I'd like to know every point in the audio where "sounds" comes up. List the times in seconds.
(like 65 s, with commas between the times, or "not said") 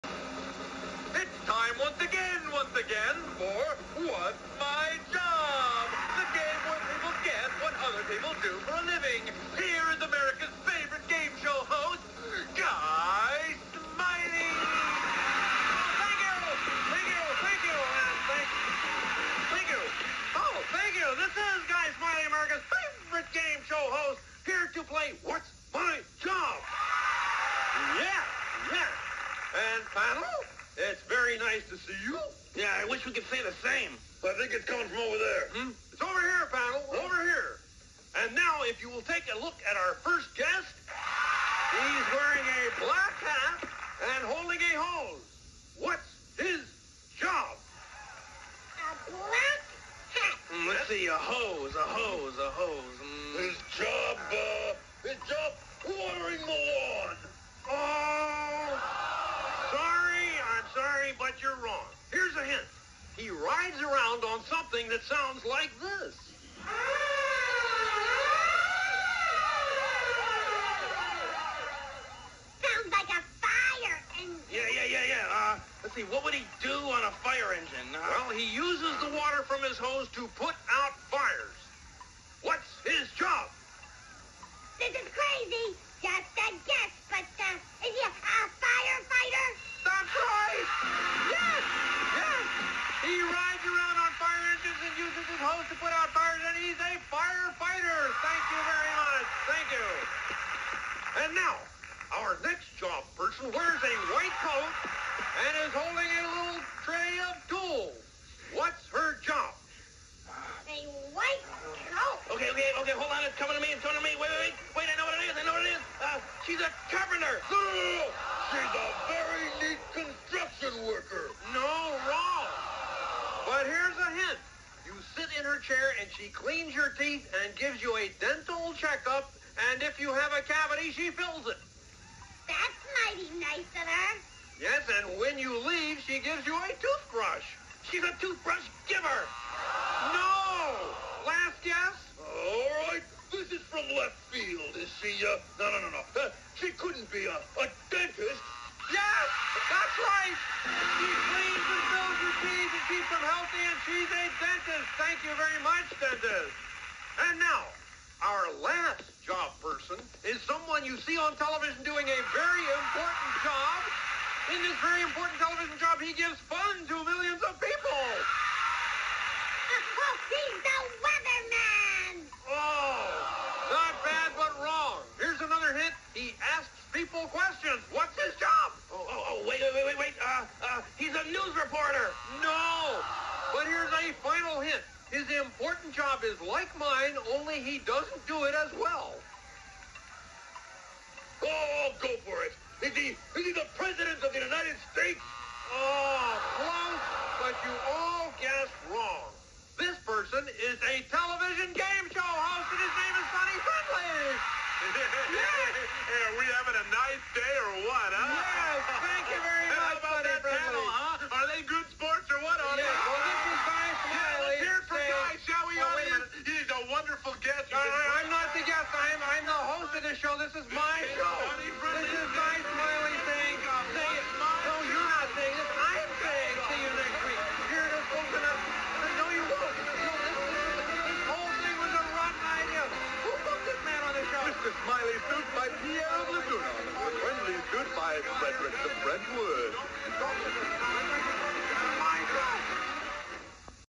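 65 s, 72 s.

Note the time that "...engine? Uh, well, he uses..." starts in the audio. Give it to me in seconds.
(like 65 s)
77 s.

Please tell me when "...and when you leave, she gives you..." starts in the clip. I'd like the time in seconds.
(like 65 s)
135 s.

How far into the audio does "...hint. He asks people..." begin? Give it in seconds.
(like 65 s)
175 s.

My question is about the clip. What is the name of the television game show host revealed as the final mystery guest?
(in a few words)
Sonny Friendly.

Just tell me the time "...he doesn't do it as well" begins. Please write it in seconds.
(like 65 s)
187 s.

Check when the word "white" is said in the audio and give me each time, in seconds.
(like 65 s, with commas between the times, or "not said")
104 s, 111 s.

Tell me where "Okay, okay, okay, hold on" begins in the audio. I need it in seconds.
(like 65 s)
112 s.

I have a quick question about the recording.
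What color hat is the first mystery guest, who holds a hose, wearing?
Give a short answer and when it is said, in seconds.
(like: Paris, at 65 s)
Black, at 42 s.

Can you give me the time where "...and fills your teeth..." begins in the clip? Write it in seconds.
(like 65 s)
151 s.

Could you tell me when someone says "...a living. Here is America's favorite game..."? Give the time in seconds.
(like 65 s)
8 s.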